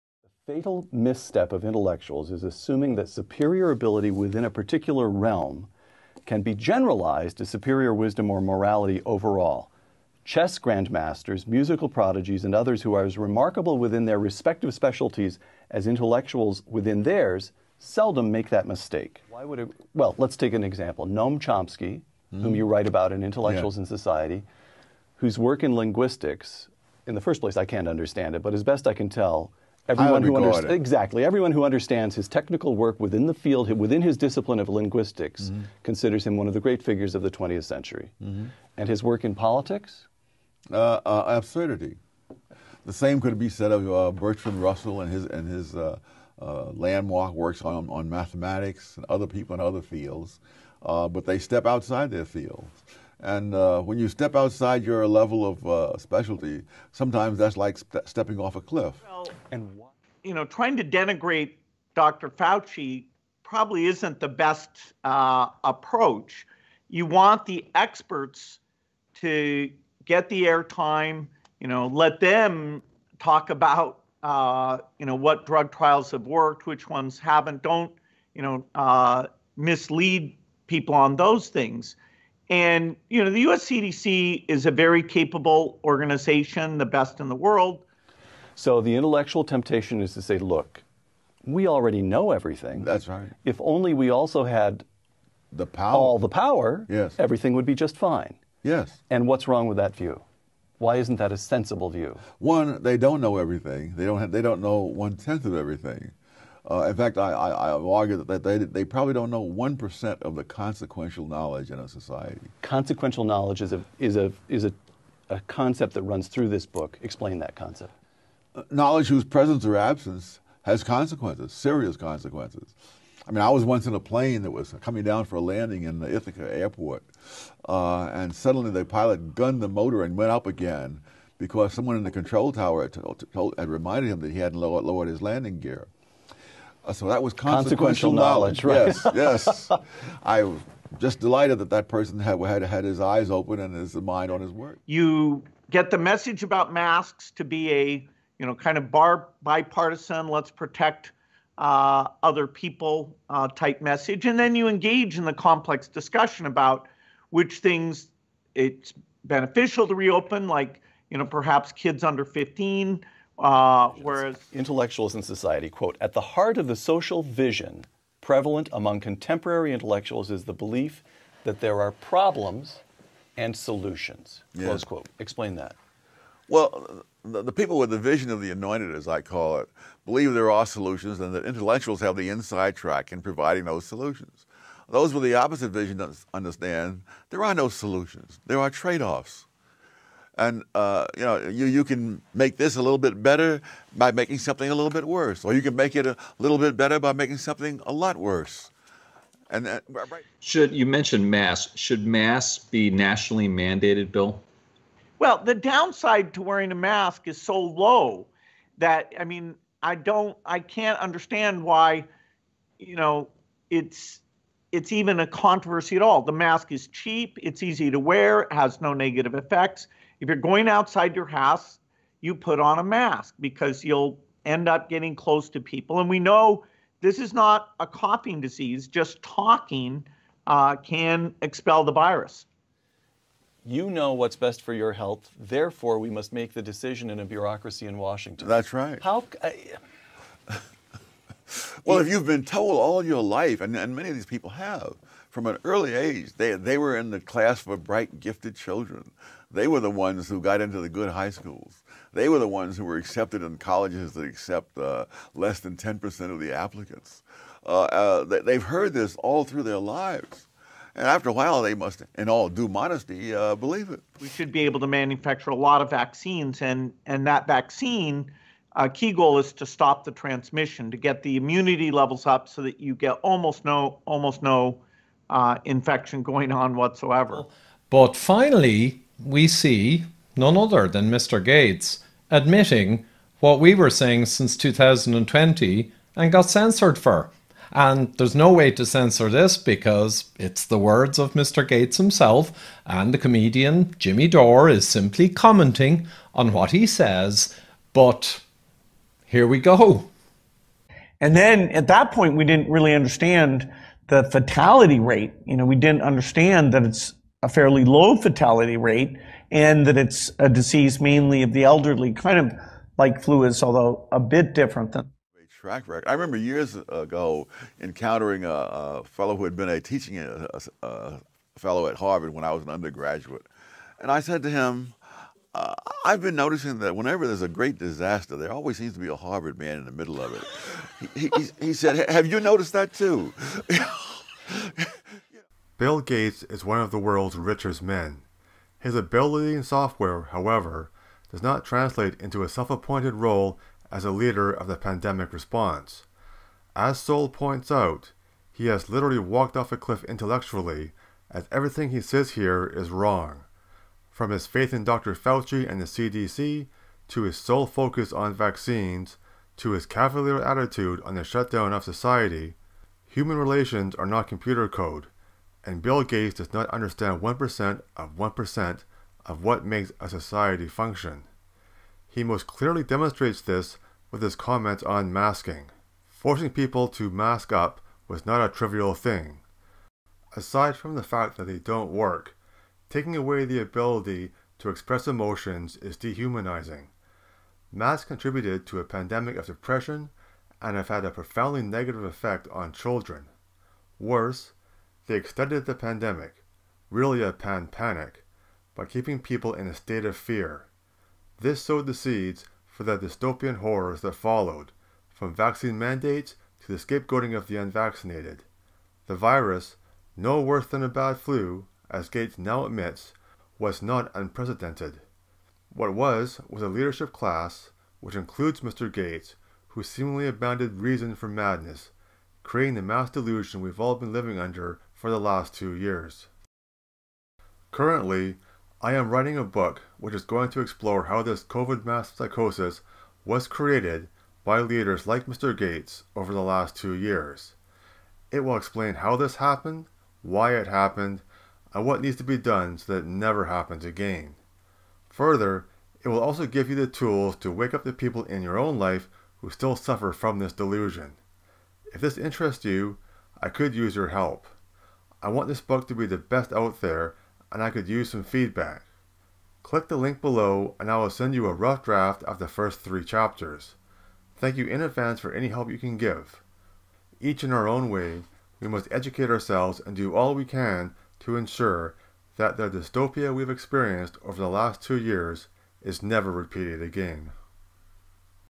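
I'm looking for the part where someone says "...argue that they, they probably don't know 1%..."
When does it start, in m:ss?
1:47.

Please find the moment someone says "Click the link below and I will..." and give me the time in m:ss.
7:39.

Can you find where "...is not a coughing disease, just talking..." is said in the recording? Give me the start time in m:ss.
3:47.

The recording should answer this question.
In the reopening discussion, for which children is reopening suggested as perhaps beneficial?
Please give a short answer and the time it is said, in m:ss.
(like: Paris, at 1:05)
kids under 15, at 2:41.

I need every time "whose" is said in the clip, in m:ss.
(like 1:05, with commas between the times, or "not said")
0:25, 1:59.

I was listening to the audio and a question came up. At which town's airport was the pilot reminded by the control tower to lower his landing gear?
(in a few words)
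Ithaca.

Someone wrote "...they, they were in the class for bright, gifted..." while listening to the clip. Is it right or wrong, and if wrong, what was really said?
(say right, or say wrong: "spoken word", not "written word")
right.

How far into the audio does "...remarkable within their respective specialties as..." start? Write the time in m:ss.
0:13.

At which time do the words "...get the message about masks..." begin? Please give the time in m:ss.
2:25.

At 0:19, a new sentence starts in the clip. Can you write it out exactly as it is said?
Why would it, well, let's take an example.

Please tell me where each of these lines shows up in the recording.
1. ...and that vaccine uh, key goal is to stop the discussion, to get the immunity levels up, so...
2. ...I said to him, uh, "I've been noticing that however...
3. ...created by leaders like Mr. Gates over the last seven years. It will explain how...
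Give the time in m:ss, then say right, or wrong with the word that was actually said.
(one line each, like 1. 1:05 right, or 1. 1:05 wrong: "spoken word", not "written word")
1. 4:27 wrong: "transmission", not "discussion"
2. 5:24 wrong: "whenever", not "however"
3. 7:13 wrong: "two", not "seven".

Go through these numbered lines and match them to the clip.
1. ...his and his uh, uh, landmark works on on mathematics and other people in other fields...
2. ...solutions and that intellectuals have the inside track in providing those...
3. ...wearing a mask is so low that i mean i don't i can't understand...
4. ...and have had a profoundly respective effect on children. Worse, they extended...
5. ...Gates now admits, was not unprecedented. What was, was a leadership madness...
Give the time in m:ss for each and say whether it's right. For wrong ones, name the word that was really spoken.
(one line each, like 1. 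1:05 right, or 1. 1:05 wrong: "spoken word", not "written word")
1. 0:45 right
2. 3:00 right
3. 3:26 right
4. 6:30 wrong: "negative", not "respective"
5. 6:52 wrong: "class", not "madness".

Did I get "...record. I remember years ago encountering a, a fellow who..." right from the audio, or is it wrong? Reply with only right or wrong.
right.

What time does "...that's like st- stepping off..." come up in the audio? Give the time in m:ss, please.
0:57.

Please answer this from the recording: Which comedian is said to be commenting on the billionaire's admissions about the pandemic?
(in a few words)
Jimmy Dore.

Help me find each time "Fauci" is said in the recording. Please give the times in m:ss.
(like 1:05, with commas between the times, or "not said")
1:02, 5:55.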